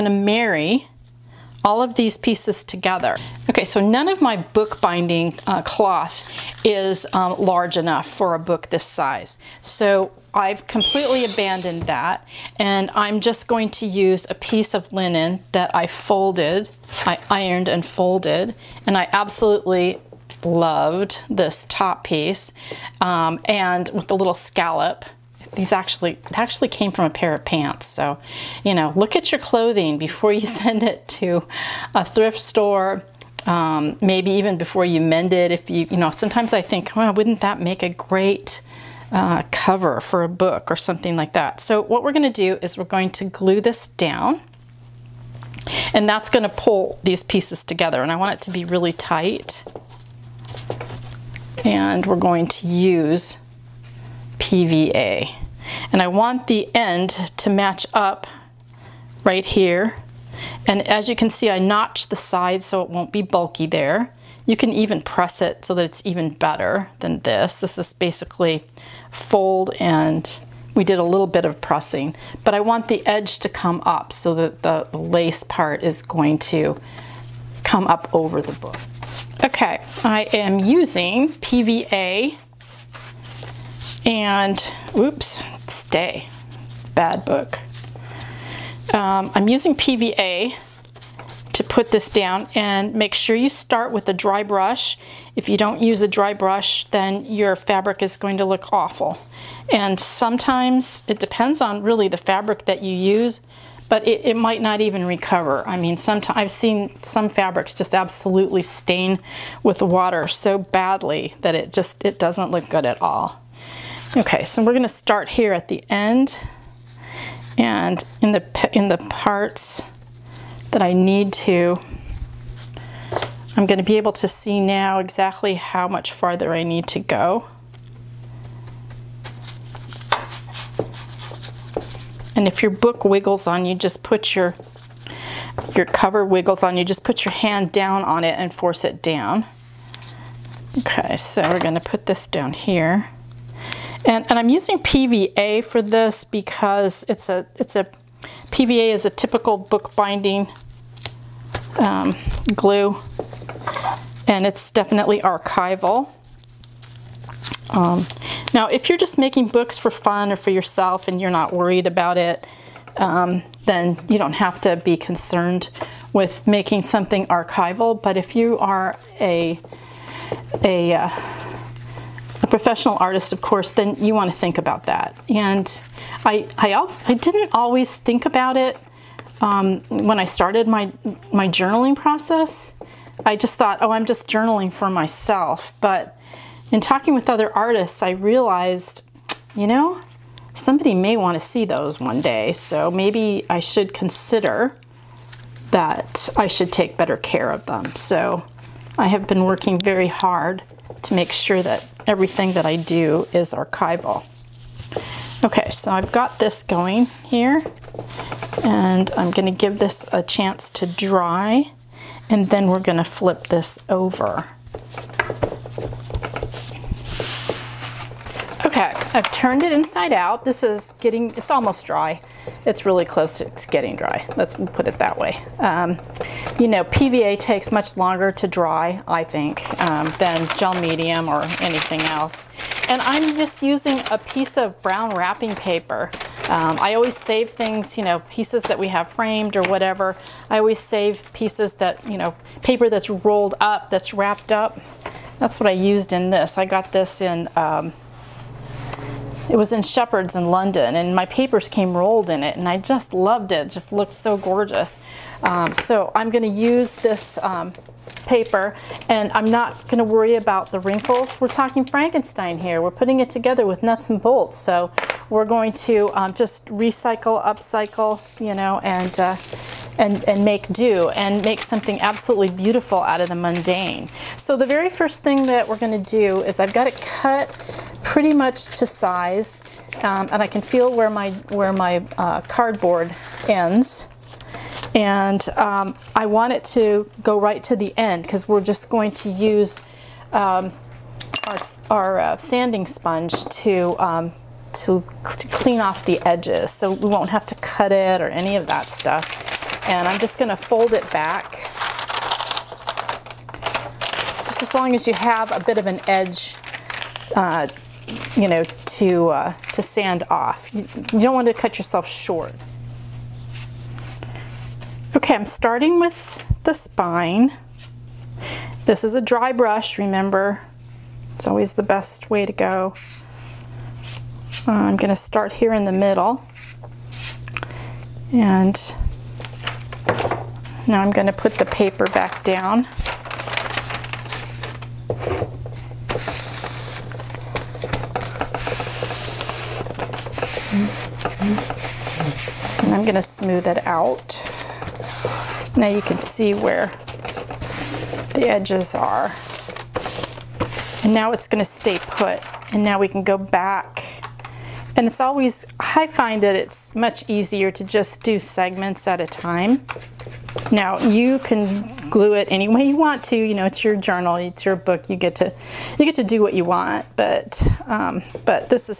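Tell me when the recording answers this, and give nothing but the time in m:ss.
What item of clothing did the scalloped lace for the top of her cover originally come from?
0:27.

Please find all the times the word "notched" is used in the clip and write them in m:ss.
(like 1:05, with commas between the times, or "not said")
1:01.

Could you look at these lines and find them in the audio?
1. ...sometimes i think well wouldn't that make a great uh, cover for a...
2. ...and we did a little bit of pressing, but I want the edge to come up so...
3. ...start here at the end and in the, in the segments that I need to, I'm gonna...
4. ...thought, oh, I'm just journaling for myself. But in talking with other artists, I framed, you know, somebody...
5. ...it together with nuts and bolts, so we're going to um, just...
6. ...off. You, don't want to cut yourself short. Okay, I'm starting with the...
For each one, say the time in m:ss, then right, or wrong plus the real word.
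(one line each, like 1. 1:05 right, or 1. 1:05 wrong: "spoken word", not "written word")
1. 0:36 right
2. 1:09 right
3. 1:54 wrong: "parts", not "segments"
4. 3:03 wrong: "realized", not "framed"
5. 4:23 right
6. 5:10 right.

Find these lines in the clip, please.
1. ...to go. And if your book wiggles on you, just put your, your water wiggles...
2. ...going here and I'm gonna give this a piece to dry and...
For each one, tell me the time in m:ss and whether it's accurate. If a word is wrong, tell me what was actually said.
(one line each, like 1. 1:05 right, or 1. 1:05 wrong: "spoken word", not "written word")
1. 2:06 wrong: "cover", not "water"
2. 3:26 wrong: "chance", not "piece".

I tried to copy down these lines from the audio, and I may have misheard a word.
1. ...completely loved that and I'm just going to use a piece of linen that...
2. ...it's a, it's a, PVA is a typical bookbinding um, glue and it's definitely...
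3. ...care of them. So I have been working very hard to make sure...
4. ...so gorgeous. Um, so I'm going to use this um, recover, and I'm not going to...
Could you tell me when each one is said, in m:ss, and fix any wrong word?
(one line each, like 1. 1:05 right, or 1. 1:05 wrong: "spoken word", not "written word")
1. 0:10 wrong: "abandoned", not "loved"
2. 2:27 right
3. 3:17 right
4. 4:14 wrong: "paper", not "recover".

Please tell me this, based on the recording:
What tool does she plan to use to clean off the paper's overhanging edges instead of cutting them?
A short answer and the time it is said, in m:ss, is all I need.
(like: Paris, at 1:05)
sanding sponge, at 4:52.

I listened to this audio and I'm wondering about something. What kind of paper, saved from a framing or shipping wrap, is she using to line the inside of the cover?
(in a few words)
brown wrapping paper.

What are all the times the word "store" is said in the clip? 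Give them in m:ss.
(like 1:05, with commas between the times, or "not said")
0:32.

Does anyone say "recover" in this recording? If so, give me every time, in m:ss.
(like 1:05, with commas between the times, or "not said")
1:45.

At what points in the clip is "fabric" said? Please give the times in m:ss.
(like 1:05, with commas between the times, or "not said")
1:37, 1:42, 1:47.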